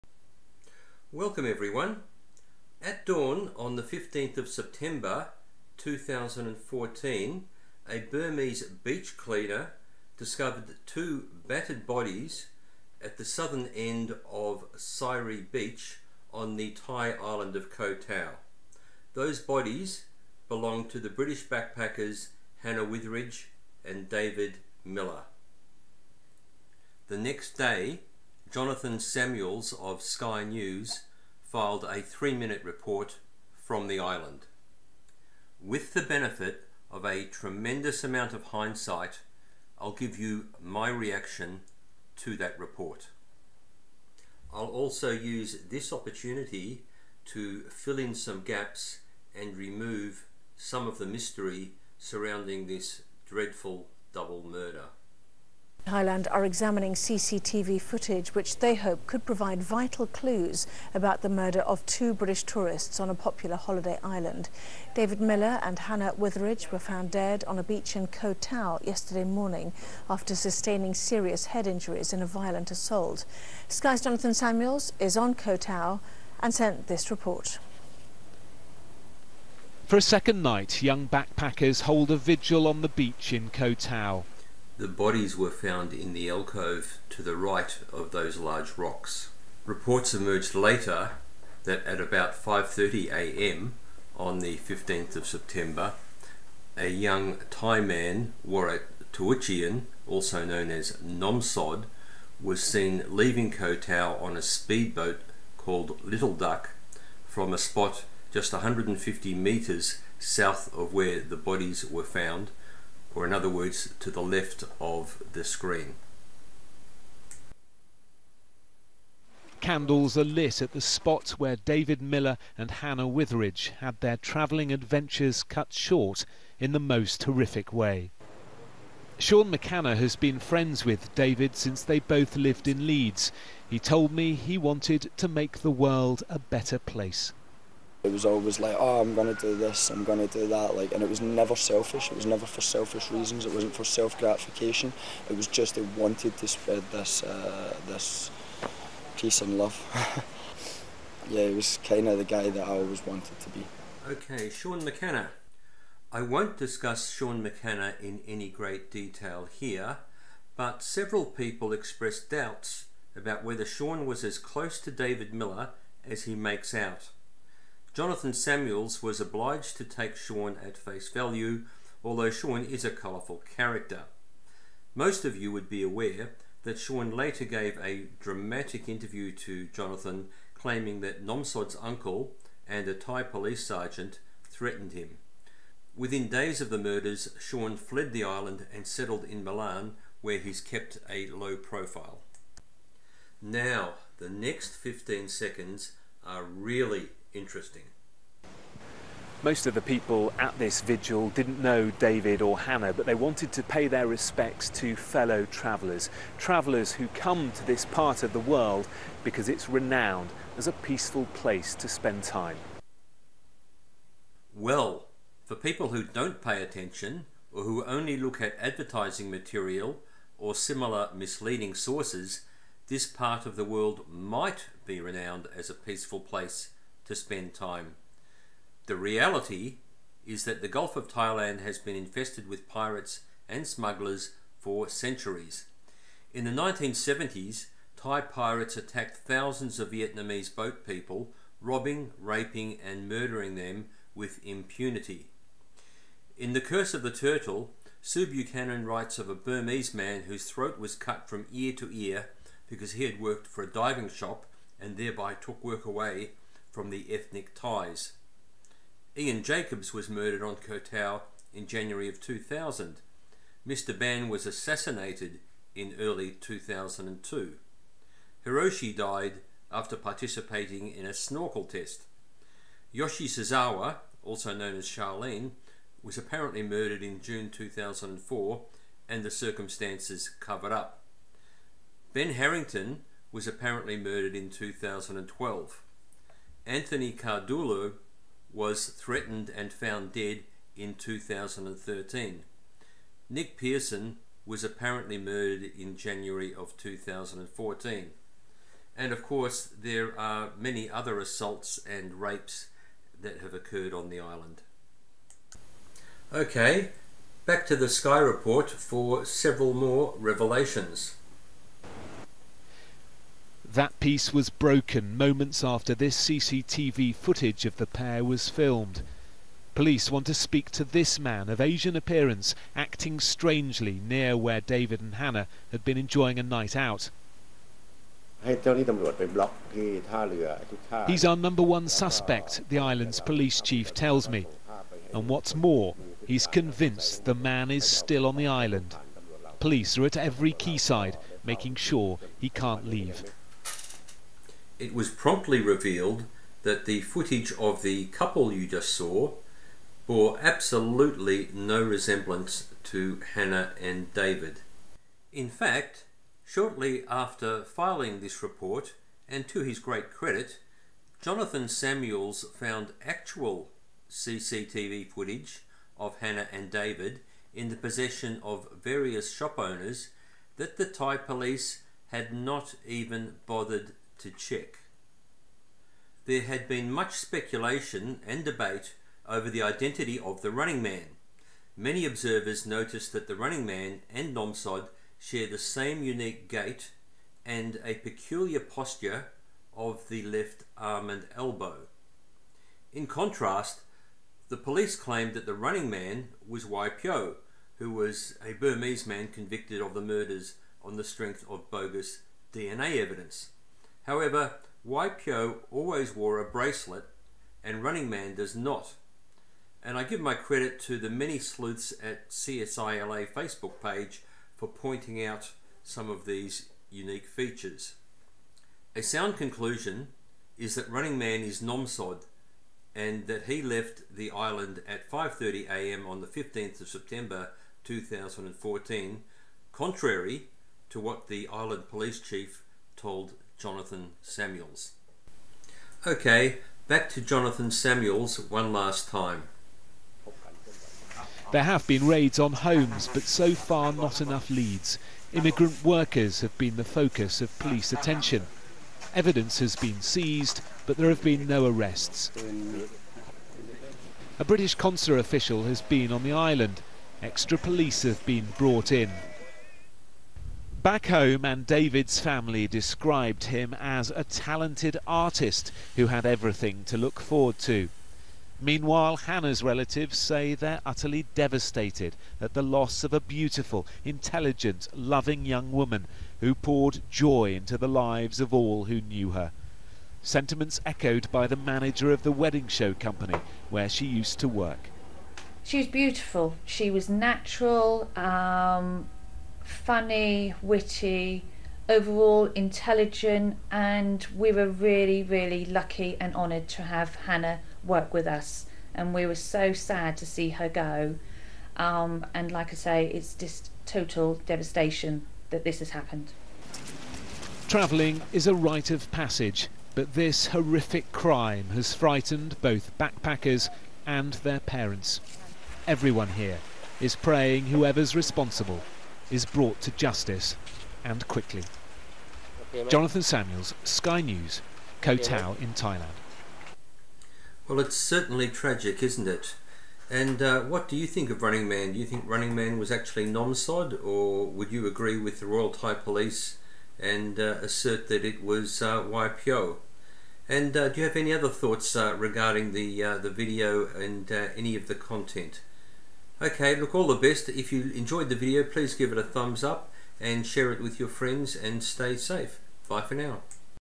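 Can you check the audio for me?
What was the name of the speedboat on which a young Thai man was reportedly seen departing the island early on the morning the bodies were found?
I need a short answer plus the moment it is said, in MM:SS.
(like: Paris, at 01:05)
Little Duck, at 01:46.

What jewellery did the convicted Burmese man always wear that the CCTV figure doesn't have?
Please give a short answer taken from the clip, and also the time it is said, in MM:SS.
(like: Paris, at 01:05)
Bracelet, at 06:46.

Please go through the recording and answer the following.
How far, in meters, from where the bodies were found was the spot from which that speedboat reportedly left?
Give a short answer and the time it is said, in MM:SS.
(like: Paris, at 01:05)
150 meters, at 01:48.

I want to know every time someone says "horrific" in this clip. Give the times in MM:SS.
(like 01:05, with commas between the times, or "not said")
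02:07, 08:30.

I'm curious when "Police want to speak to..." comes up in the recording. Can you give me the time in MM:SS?
05:19.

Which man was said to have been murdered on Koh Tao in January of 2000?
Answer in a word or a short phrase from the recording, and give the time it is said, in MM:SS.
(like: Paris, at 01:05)
Ian Jacobs, at 04:19.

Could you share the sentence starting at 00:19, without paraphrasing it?
Those bodies belonged to the British backpackers Hannah Witheridge and David Miller.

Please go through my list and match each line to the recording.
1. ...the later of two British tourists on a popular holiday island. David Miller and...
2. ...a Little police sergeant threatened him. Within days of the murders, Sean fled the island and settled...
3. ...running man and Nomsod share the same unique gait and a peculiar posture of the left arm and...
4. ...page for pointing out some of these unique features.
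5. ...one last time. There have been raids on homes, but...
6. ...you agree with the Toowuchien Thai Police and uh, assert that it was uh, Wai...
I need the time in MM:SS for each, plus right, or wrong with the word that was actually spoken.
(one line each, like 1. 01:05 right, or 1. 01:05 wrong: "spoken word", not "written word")
1. 01:01 wrong: "murder", not "later"
2. 03:02 wrong: "Thai", not "Little"
3. 06:23 right
4. 06:53 right
5. 07:18 right
6. 08:54 wrong: "Royal", not "Toowuchien".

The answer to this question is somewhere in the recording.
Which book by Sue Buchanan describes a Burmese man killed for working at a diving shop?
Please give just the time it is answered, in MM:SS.
04:06.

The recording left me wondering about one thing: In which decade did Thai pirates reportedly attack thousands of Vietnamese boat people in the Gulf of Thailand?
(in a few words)
1970s.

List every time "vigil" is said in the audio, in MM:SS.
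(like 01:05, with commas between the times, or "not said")
01:22, 03:20.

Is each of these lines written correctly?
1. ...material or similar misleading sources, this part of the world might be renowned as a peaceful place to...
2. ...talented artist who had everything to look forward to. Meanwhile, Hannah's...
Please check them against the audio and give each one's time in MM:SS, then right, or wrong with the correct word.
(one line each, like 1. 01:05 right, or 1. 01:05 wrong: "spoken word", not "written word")
1. 03:39 right
2. 07:44 right.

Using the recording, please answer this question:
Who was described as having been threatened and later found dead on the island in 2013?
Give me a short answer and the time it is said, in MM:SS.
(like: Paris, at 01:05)
Anthony Cardullo, at 04:46.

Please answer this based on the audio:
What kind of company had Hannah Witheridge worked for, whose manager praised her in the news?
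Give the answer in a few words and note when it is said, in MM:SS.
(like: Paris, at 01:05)
Wedding show company, at 08:02.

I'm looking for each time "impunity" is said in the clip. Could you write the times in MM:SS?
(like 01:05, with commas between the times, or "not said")
04:04.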